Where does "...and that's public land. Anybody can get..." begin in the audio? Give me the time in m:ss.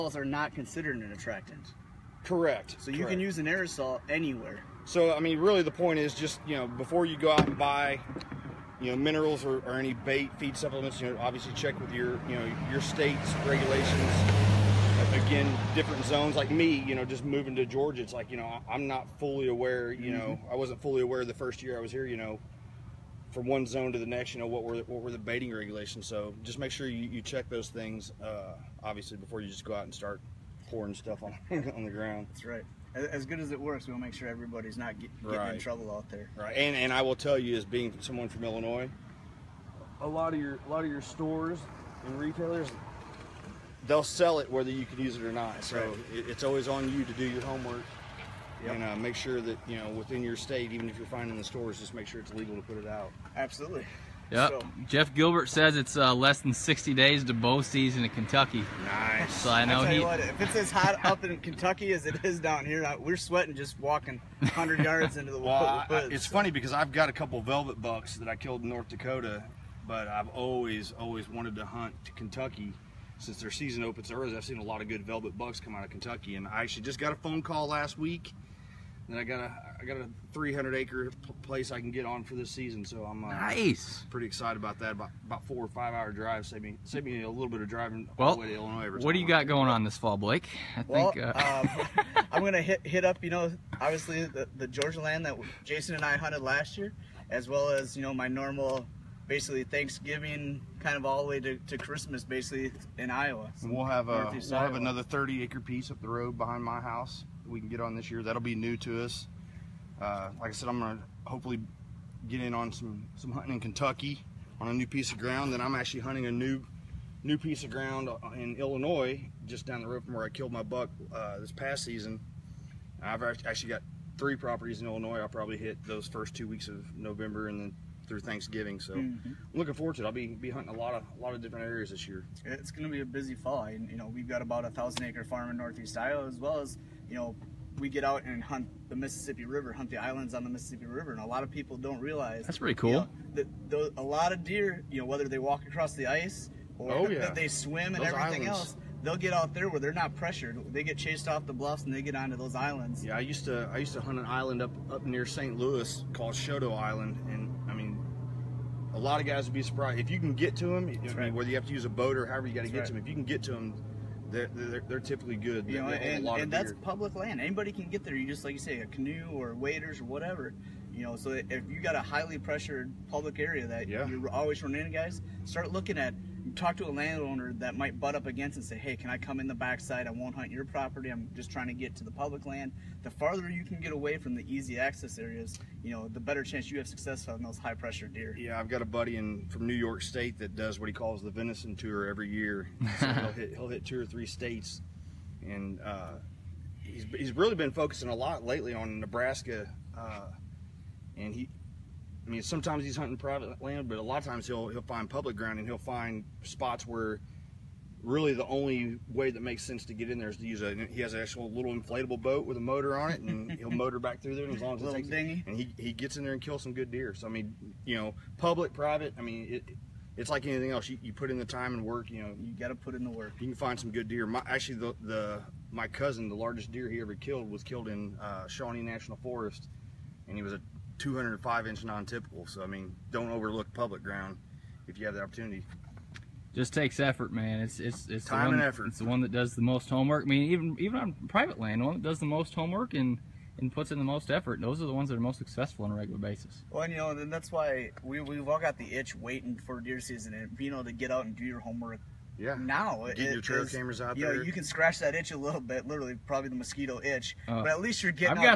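2:46.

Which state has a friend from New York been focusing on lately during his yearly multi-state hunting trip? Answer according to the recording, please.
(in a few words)
Nebraska.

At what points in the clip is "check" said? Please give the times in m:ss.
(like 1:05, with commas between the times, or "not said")
0:11, 0:27.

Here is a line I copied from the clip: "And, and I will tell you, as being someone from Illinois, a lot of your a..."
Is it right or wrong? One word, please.
right.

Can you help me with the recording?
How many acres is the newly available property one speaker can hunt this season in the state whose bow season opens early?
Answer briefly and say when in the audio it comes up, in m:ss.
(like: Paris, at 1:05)
300, at 1:20.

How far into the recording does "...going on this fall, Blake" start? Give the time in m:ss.
1:29.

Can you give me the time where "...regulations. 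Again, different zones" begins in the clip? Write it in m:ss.
0:13.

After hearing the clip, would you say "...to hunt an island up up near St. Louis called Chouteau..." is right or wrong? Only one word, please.
right.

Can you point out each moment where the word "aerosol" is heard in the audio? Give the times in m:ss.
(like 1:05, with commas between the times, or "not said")
0:03.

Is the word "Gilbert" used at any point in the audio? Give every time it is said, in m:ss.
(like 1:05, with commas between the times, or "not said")
0:55.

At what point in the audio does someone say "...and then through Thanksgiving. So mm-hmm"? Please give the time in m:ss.
2:07.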